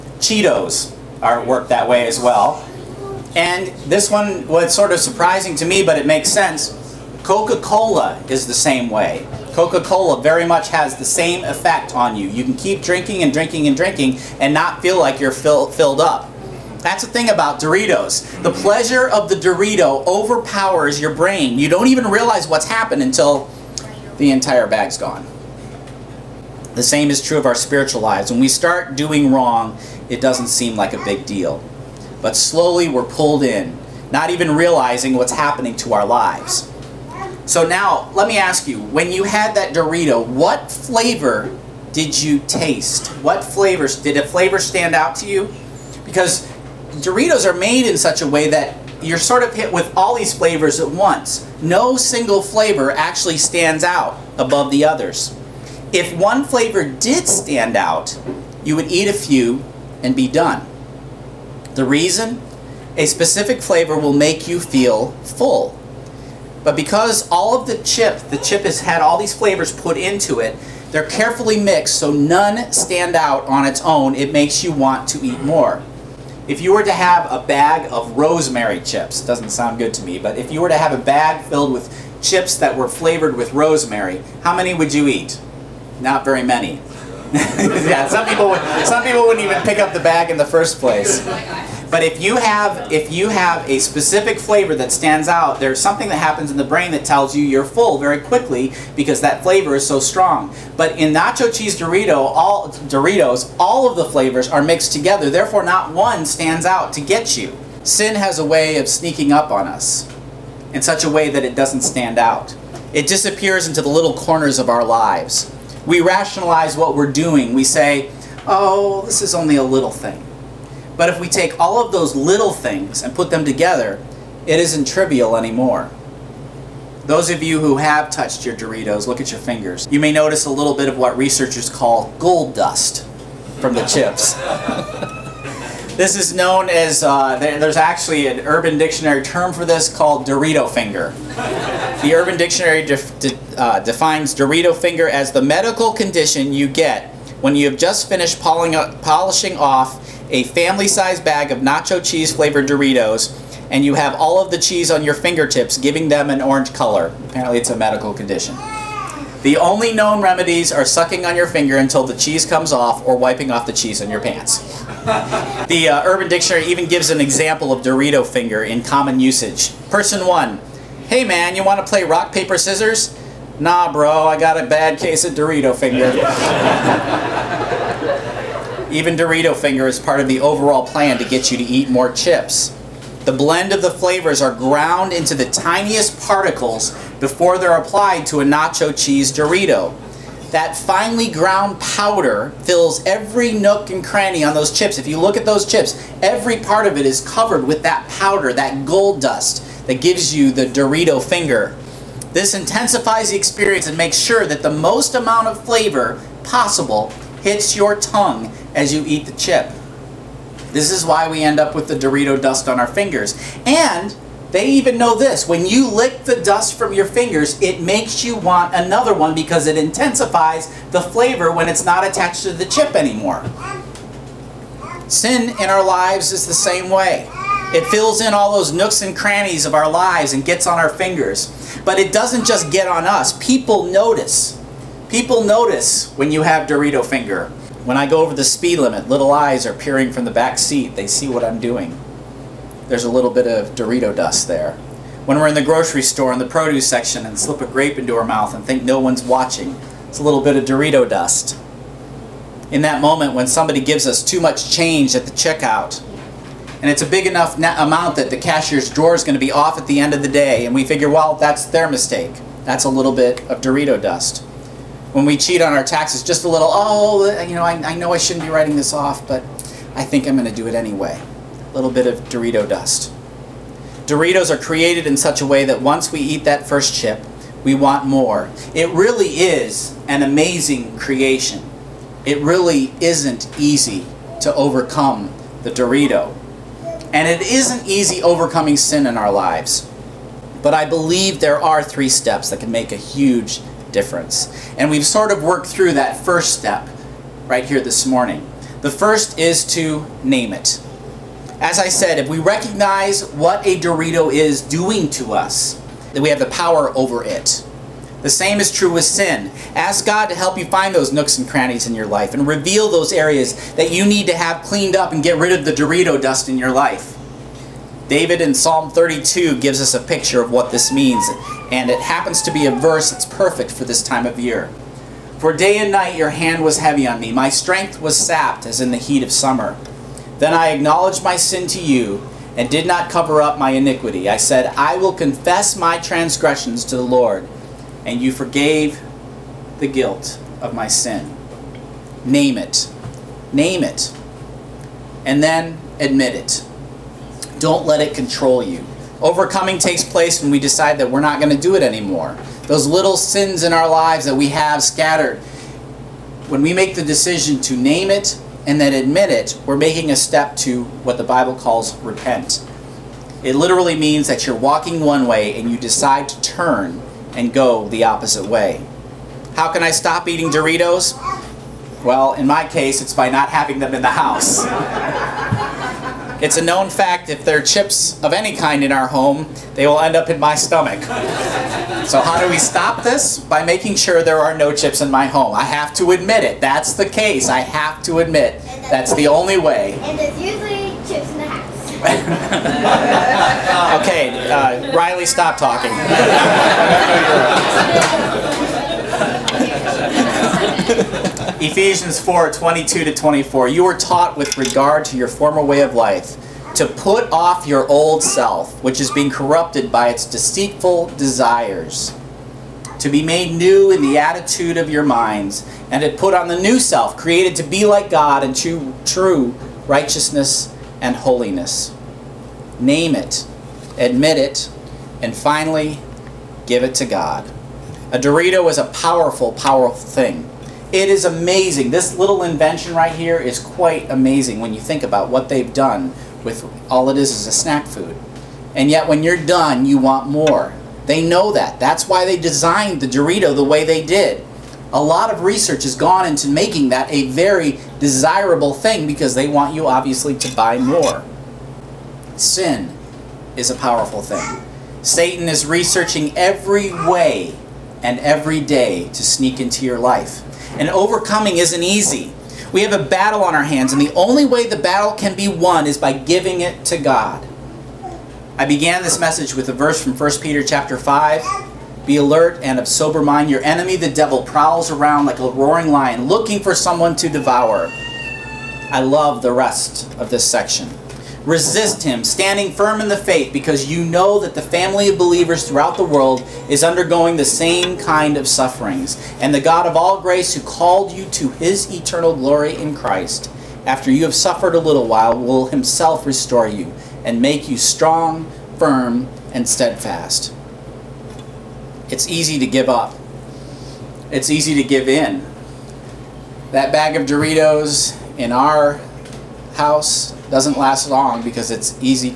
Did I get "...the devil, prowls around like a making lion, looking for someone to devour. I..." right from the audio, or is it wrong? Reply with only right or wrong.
wrong.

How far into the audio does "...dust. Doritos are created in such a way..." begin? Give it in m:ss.
4:32.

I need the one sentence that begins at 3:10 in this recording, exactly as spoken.
That finely ground powder fills every nook and cranny on those chips.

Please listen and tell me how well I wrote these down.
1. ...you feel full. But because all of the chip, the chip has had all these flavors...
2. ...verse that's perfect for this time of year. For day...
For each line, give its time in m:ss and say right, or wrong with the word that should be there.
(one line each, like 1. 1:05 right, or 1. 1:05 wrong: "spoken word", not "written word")
1. 1:04 right
2. 5:22 right.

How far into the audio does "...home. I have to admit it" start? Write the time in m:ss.
6:25.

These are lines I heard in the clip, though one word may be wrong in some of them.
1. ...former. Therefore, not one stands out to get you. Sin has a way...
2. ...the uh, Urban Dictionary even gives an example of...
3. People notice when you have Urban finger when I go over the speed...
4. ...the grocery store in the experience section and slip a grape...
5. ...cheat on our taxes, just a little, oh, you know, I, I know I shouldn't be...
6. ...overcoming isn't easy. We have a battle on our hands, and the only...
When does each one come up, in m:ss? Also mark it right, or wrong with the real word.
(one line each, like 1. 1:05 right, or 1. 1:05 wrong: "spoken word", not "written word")
1. 1:44 wrong: "together", not "former"
2. 2:45 right
3. 3:55 wrong: "Dorito", not "Urban"
4. 4:05 wrong: "produce", not "experience"
5. 4:25 right
6. 7:40 right.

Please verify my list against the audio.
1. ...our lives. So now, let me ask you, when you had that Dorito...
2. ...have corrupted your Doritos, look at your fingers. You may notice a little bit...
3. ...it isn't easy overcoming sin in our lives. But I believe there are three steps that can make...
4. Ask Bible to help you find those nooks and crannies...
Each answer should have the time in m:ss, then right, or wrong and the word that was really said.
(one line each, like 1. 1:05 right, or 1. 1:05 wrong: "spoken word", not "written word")
1. 0:35 right
2. 2:07 wrong: "touched", not "corrupted"
3. 4:47 right
4. 5:09 wrong: "God", not "Bible".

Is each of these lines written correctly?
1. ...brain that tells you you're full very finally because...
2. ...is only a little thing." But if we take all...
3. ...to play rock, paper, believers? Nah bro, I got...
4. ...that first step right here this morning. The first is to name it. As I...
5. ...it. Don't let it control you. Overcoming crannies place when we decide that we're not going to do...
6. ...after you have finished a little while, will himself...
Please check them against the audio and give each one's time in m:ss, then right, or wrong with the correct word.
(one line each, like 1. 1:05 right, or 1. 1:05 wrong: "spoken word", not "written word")
1. 1:36 wrong: "quickly", not "finally"
2. 1:59 right
3. 2:51 wrong: "scissors", not "believers"
4. 4:55 right
5. 5:46 wrong: "takes", not "crannies"
6. 8:13 wrong: "suffered", not "finished".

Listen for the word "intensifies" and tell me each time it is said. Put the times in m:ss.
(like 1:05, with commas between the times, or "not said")
3:22, 3:39.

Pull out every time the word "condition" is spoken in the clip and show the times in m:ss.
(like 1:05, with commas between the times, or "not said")
2:25, 2:38.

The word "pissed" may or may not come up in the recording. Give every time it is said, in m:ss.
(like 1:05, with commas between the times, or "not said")
not said.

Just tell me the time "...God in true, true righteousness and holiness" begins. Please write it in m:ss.
6:58.